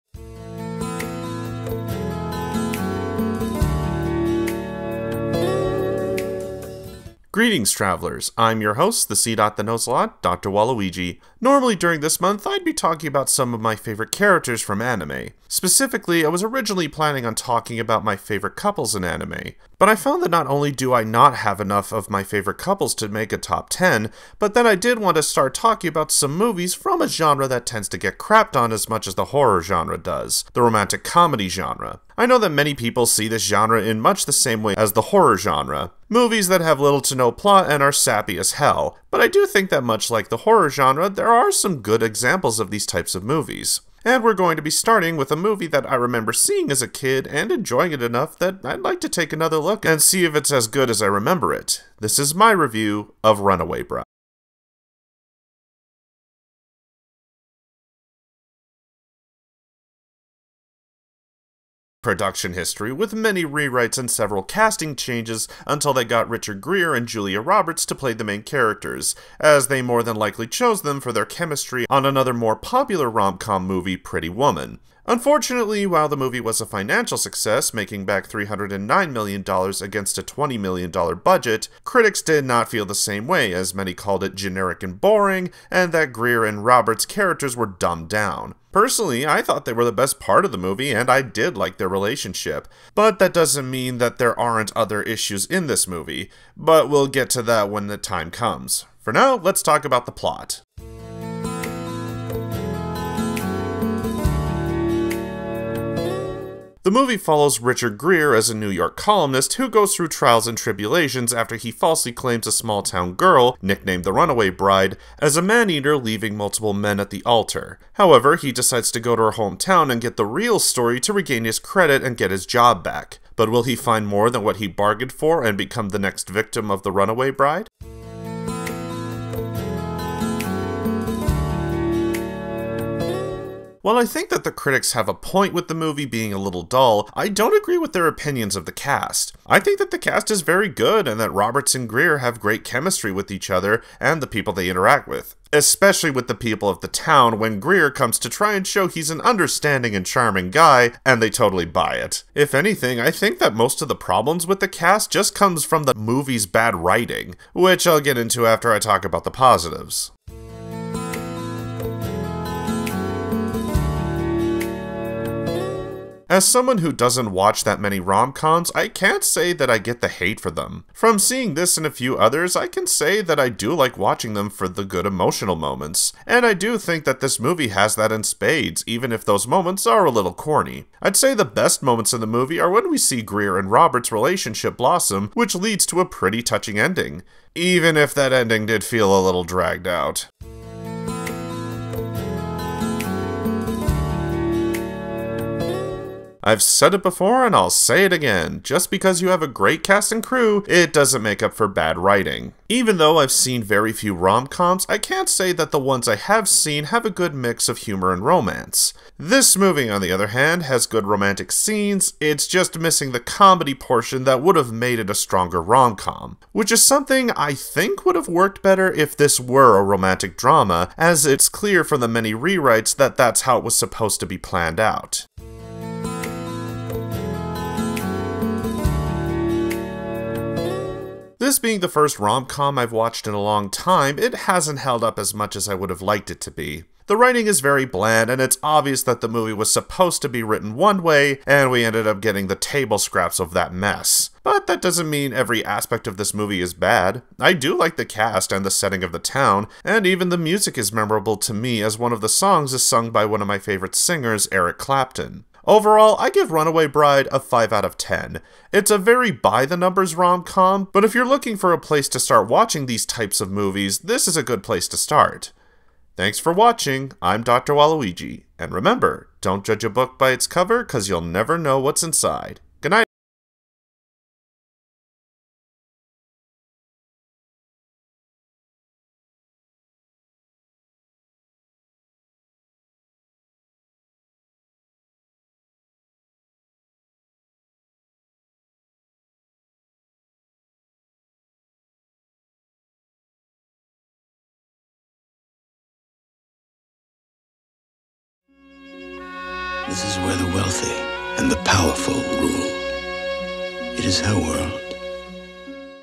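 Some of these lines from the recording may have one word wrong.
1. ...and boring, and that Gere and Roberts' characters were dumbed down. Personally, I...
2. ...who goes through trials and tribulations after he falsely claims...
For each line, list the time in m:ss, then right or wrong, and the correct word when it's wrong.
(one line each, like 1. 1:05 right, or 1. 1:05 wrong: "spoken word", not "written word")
1. 1:24 right
2. 1:49 right.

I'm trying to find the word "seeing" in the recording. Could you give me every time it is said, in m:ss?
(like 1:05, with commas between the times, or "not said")
0:46, 2:51.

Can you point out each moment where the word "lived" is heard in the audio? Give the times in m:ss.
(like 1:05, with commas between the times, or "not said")
not said.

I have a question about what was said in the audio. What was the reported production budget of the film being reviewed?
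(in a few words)
$20 million.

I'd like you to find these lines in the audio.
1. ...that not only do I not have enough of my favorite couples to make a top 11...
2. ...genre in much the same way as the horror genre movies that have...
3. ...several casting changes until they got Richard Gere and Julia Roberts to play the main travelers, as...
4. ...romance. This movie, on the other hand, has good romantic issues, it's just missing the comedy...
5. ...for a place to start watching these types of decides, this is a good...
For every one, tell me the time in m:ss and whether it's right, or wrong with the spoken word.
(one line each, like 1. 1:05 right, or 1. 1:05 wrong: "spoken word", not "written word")
1. 0:20 wrong: "10", not "11"
2. 0:33 right
3. 1:04 wrong: "characters", not "travelers"
4. 3:28 wrong: "scenes", not "issues"
5. 4:21 wrong: "movies", not "decides".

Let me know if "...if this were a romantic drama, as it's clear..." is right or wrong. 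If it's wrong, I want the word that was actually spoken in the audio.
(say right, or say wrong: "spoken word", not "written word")
right.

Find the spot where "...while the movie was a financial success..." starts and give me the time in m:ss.
1:15.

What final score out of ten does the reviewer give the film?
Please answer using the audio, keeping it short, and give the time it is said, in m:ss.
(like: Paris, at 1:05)
5, at 4:17.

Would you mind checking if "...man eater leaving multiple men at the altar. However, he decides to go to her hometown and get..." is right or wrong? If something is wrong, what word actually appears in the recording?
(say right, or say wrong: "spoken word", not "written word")
right.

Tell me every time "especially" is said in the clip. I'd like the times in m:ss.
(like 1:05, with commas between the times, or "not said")
2:25.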